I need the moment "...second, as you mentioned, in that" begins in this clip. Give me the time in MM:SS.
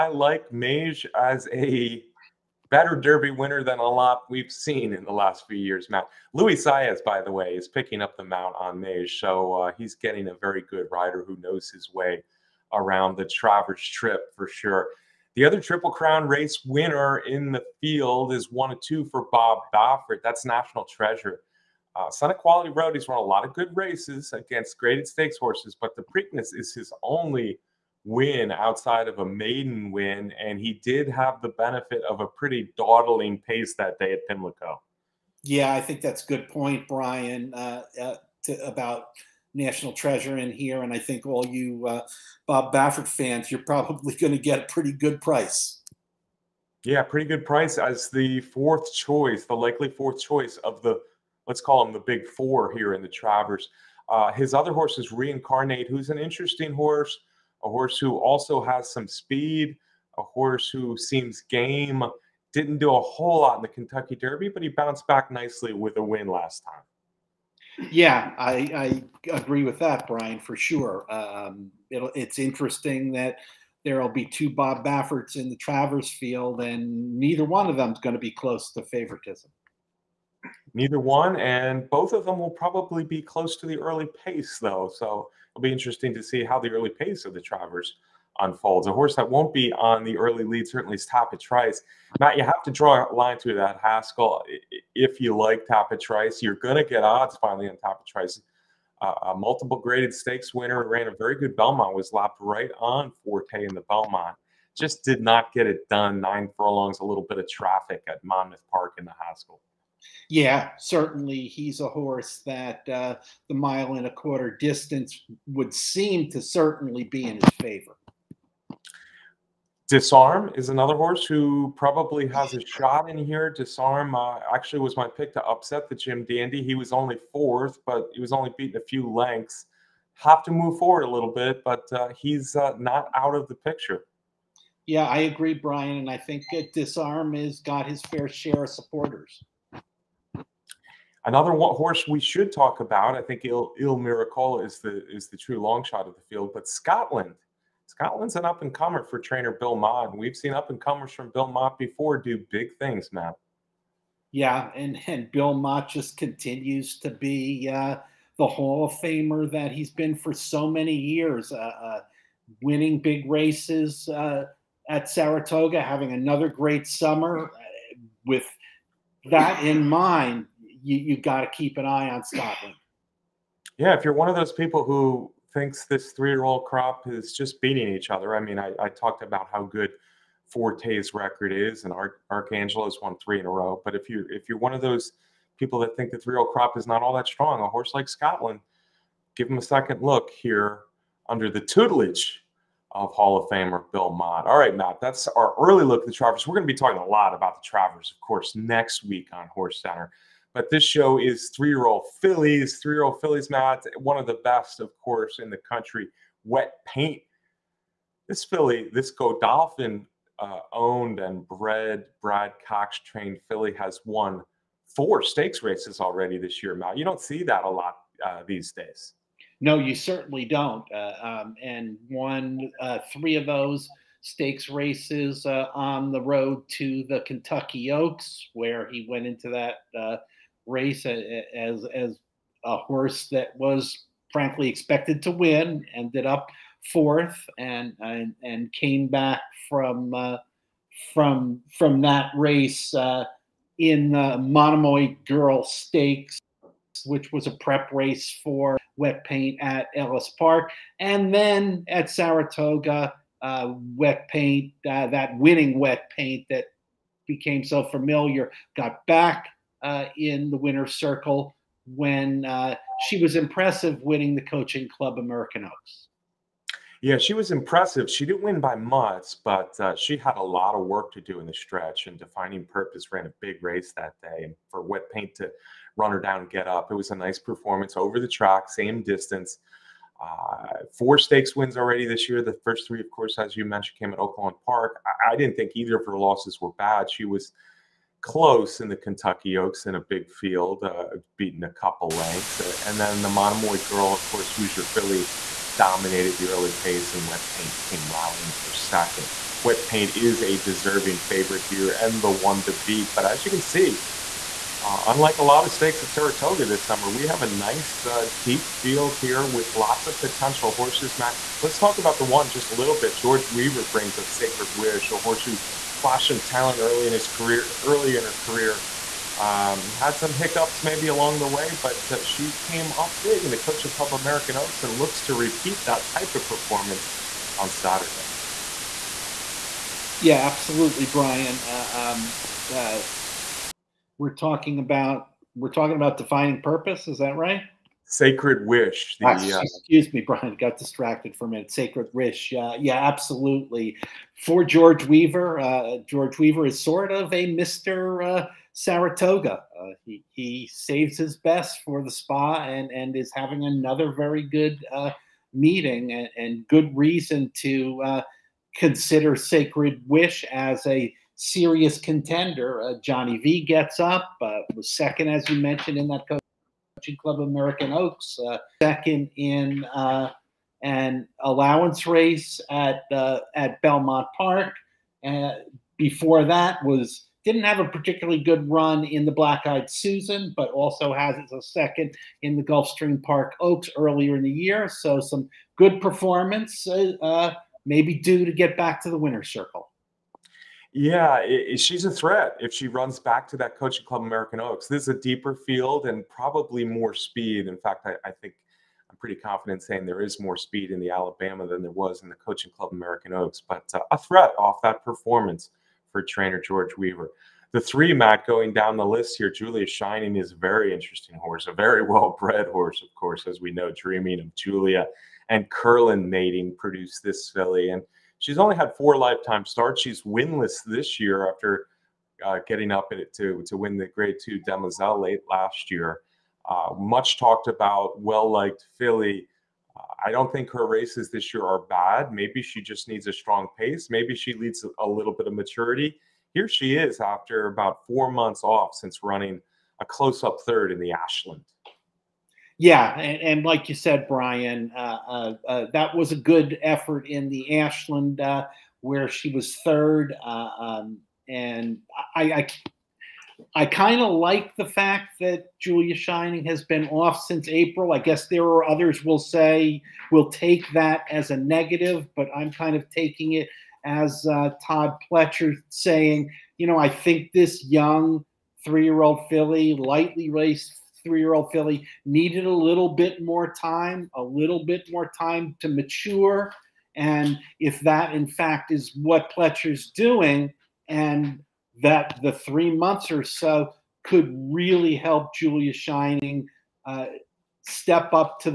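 06:04.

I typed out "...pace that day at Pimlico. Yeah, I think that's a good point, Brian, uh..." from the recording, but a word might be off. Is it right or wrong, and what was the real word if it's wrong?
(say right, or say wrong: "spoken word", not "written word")
right.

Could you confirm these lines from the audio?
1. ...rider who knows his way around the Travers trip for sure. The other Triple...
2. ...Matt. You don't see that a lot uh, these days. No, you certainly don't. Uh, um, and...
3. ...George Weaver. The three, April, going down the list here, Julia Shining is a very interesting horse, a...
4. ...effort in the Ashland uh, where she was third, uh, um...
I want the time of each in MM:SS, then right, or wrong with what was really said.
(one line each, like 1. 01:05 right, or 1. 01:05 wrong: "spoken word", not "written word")
1. 00:10 right
2. 03:36 right
3. 06:46 wrong: "Matt", not "April"
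4. 07:26 right.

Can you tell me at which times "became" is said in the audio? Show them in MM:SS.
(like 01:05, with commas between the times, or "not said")
04:17.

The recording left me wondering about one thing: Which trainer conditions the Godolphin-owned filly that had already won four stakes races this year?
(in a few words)
Brad Cox.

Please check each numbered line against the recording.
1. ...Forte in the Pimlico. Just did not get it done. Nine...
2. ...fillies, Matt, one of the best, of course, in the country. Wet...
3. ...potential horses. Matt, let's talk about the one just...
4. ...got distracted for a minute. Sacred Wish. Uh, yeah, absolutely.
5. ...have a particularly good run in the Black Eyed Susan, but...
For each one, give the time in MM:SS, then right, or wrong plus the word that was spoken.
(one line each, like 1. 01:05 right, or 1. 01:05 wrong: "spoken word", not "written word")
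1. 01:43 wrong: "Belmont", not "Pimlico"
2. 03:23 right
3. 05:10 right
4. 05:40 right
5. 06:17 right.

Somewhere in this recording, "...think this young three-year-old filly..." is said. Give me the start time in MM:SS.
07:47.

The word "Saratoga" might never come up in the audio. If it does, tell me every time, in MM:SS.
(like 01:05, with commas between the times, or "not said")
02:45, 04:12, 05:06, 05:48.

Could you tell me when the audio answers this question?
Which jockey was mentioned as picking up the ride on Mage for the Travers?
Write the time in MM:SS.
00:06.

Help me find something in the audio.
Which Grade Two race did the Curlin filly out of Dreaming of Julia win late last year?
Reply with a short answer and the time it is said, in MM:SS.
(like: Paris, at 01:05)
Demoiselle, at 07:04.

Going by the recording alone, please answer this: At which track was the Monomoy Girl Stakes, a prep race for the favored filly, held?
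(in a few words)
Ellis Park.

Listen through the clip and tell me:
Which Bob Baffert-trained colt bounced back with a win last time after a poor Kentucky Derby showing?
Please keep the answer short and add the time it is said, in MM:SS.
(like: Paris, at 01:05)
Reincarnate, at 00:55.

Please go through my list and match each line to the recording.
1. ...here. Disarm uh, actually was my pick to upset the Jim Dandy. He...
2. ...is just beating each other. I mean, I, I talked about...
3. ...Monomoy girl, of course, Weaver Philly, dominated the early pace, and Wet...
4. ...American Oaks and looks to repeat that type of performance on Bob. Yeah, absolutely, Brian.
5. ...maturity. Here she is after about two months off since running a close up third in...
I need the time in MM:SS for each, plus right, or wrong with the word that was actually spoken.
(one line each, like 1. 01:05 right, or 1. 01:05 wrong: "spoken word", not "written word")
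1. 02:03 right
2. 02:57 right
3. 04:53 wrong: "Hoosier", not "Weaver"
4. 05:24 wrong: "Saturday", not "Bob"
5. 07:15 wrong: "four", not "two".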